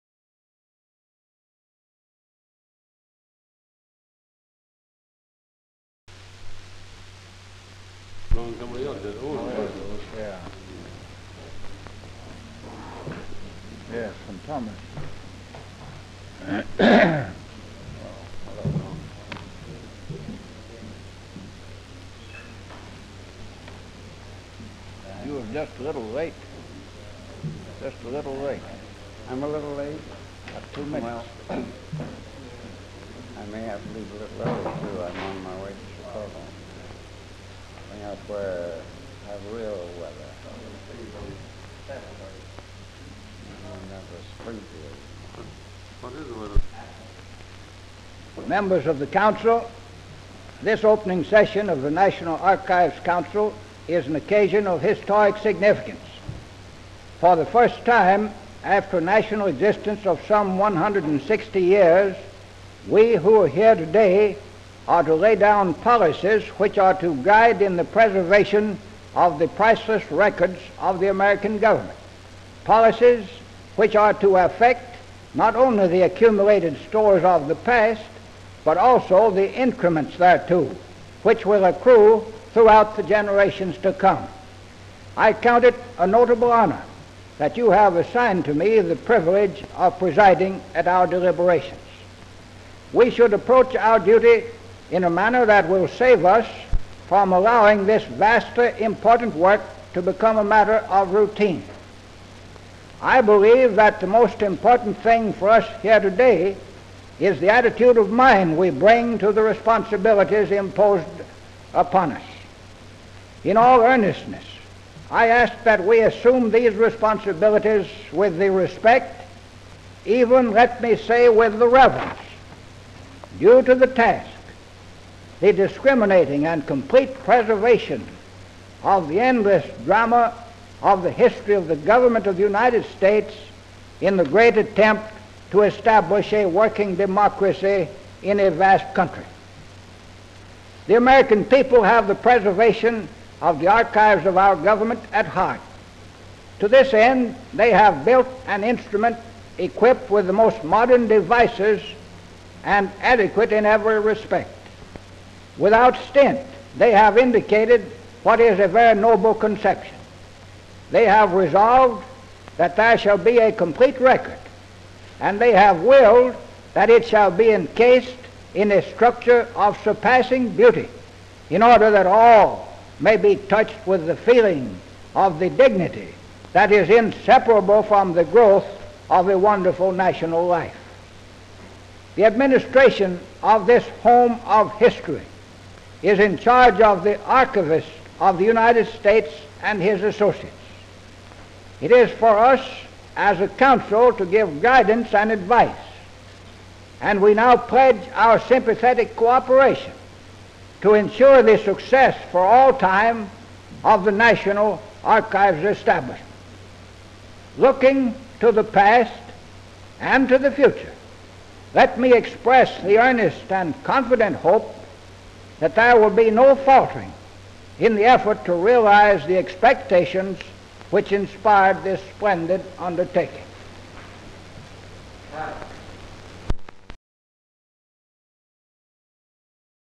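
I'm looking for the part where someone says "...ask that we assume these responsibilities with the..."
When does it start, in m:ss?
1:55.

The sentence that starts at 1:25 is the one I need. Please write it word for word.
I count it a notable honor that you have assigned to me the privilege of presiding at our deliberations.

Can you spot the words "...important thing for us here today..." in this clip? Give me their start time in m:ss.
1:44.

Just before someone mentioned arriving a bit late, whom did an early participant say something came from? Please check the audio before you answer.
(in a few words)
Thomas.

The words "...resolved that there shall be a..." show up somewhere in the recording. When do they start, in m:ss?
2:41.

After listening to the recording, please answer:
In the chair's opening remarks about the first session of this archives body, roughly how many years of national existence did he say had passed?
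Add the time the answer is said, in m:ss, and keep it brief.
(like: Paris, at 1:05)
160, at 1:00.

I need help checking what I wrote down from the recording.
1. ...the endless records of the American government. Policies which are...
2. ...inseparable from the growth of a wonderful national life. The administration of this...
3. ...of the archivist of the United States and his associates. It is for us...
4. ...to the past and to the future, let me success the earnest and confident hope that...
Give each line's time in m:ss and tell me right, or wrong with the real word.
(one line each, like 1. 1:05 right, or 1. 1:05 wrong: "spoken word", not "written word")
1. 1:09 wrong: "priceless", not "endless"
2. 2:56 right
3. 3:06 right
4. 3:28 wrong: "express", not "success".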